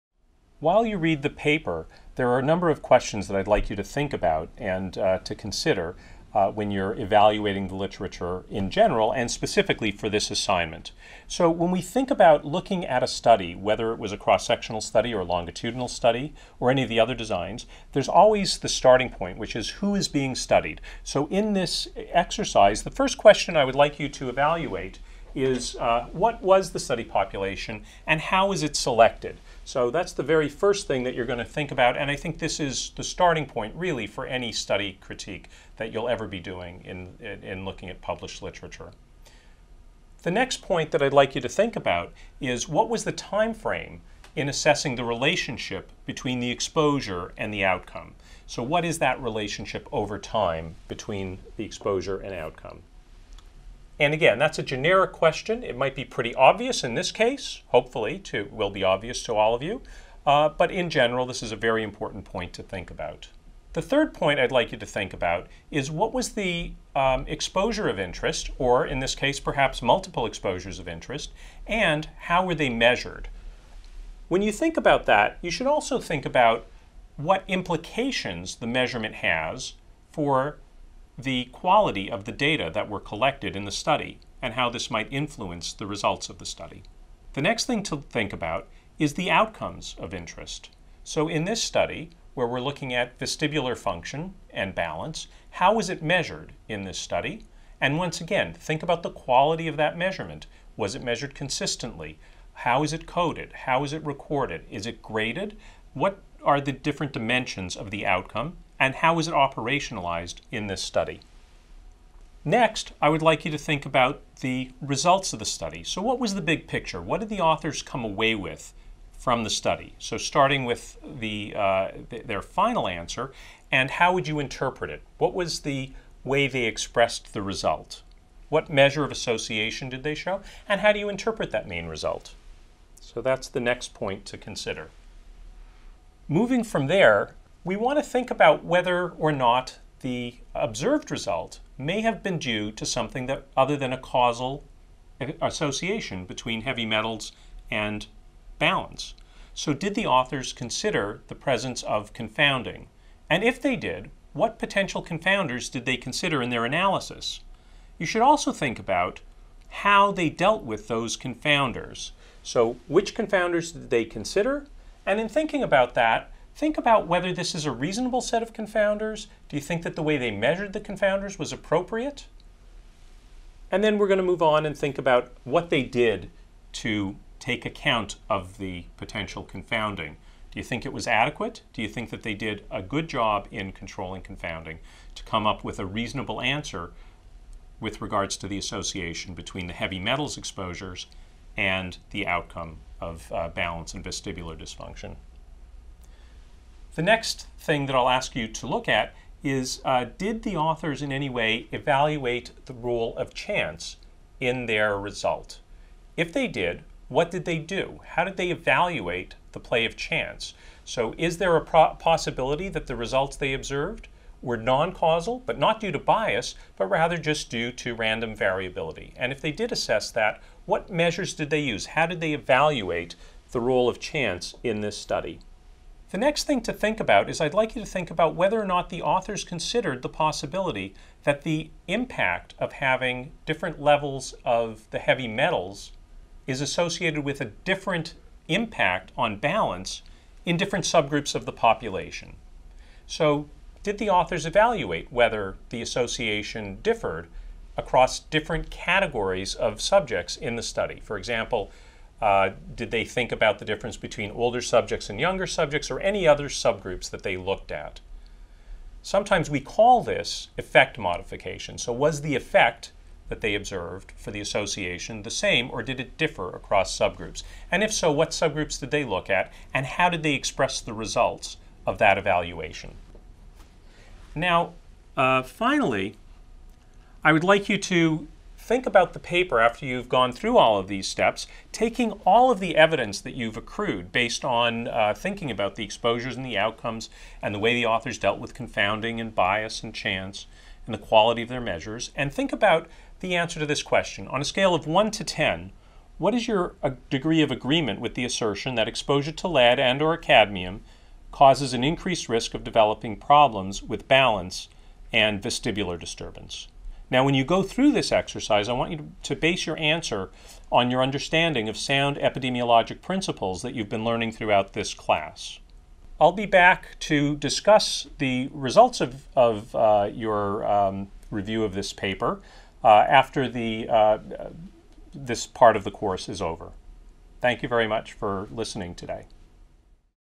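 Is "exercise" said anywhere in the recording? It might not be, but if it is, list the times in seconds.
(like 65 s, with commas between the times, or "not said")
22 s, 308 s.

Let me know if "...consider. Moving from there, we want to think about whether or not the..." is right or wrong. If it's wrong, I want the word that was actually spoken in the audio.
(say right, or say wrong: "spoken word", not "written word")
right.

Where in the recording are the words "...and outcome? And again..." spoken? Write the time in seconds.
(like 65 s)
52 s.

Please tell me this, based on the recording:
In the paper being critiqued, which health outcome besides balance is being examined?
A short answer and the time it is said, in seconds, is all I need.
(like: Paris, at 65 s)
Vestibular function, at 93 s.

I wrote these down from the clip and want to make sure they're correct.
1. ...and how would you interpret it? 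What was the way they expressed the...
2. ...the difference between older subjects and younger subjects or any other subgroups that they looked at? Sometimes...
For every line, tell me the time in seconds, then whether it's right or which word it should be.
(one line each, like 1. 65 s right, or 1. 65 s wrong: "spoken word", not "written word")
1. 123 s right
2. 253 s right.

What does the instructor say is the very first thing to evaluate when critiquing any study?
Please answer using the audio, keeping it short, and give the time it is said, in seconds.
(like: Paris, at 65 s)
Study population, at 26 s.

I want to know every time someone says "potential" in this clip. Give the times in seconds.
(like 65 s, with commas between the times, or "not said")
154 s, 178 s.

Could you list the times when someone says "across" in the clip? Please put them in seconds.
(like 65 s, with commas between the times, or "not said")
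247 s, 266 s.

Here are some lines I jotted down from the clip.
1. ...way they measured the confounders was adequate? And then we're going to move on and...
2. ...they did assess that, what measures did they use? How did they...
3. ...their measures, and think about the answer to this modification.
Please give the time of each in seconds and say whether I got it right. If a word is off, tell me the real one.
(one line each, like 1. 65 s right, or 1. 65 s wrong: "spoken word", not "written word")
1. 170 s wrong: "appropriate", not "adequate"
2. 219 s right
3. 291 s wrong: "question", not "modification".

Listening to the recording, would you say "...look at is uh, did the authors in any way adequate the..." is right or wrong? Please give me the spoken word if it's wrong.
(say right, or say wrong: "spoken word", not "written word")
wrong: "evaluate", not "adequate".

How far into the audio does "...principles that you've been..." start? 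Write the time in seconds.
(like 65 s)
313 s.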